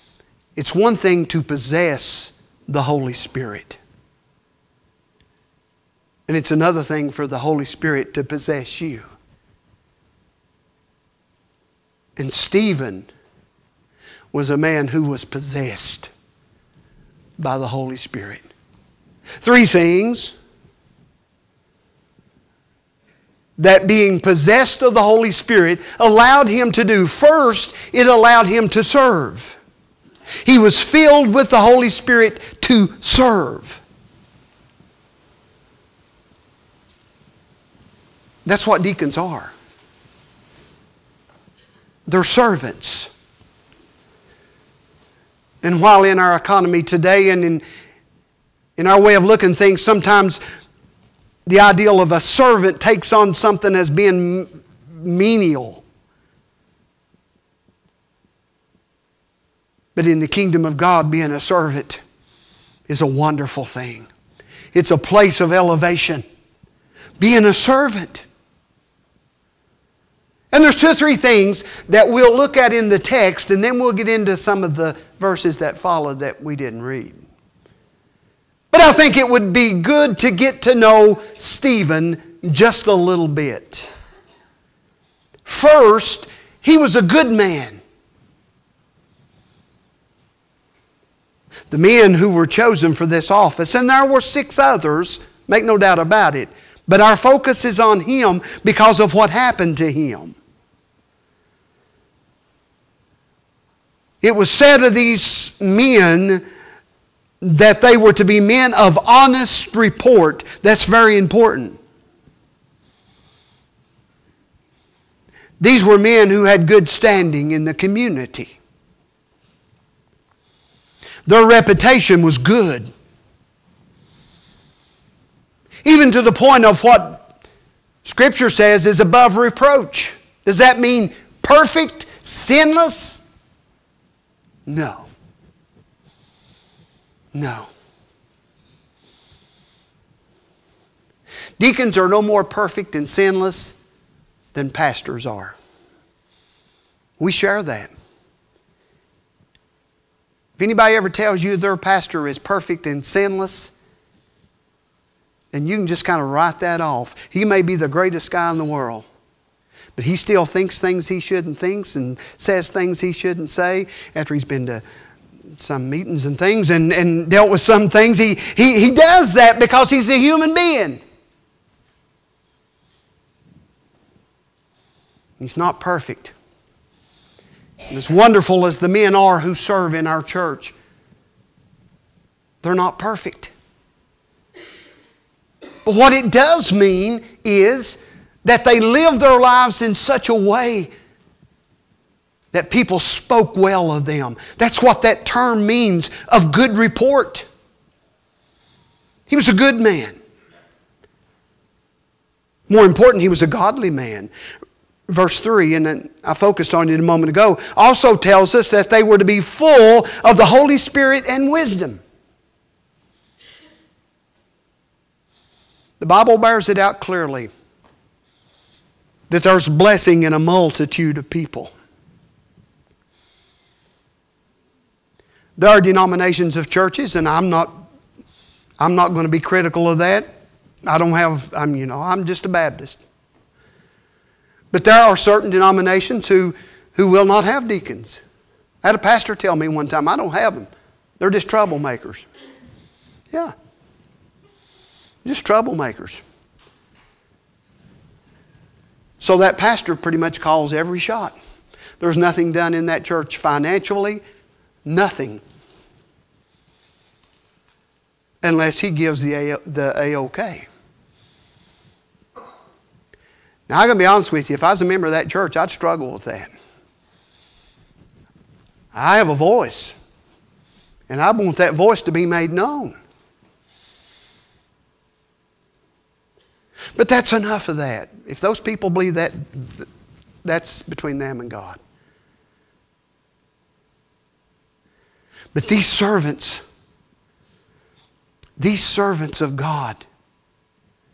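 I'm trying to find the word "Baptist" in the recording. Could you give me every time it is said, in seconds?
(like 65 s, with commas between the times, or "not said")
232 s.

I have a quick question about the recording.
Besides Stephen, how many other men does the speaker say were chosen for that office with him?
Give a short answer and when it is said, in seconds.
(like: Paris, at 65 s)
6, at 94 s.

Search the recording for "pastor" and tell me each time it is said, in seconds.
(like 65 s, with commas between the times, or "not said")
144 s, 151 s, 238 s, 249 s.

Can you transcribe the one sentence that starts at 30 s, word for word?
He was filled with the Holy Spirit to serve.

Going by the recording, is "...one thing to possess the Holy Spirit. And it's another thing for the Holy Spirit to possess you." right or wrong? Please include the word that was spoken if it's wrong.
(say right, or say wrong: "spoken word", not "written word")
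right.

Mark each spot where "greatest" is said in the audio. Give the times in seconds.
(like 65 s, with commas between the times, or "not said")
157 s.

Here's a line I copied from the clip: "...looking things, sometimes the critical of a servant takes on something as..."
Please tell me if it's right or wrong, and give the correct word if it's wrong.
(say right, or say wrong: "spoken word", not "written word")
wrong: "ideal", not "critical".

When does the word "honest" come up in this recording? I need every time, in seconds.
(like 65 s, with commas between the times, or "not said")
109 s, 264 s.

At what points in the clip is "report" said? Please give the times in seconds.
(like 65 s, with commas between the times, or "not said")
109 s, 196 s.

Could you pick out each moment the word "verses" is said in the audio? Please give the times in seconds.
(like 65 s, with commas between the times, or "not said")
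75 s, 205 s.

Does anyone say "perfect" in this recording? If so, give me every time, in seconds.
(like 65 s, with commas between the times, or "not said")
131 s, 142 s, 152 s, 175 s, 182 s.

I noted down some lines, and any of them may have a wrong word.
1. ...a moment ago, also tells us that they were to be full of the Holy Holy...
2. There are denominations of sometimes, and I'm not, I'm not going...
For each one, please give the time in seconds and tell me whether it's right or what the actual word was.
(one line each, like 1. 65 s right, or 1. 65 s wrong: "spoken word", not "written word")
1. 206 s wrong: "Spirit", not "Holy"
2. 225 s wrong: "churches", not "sometimes".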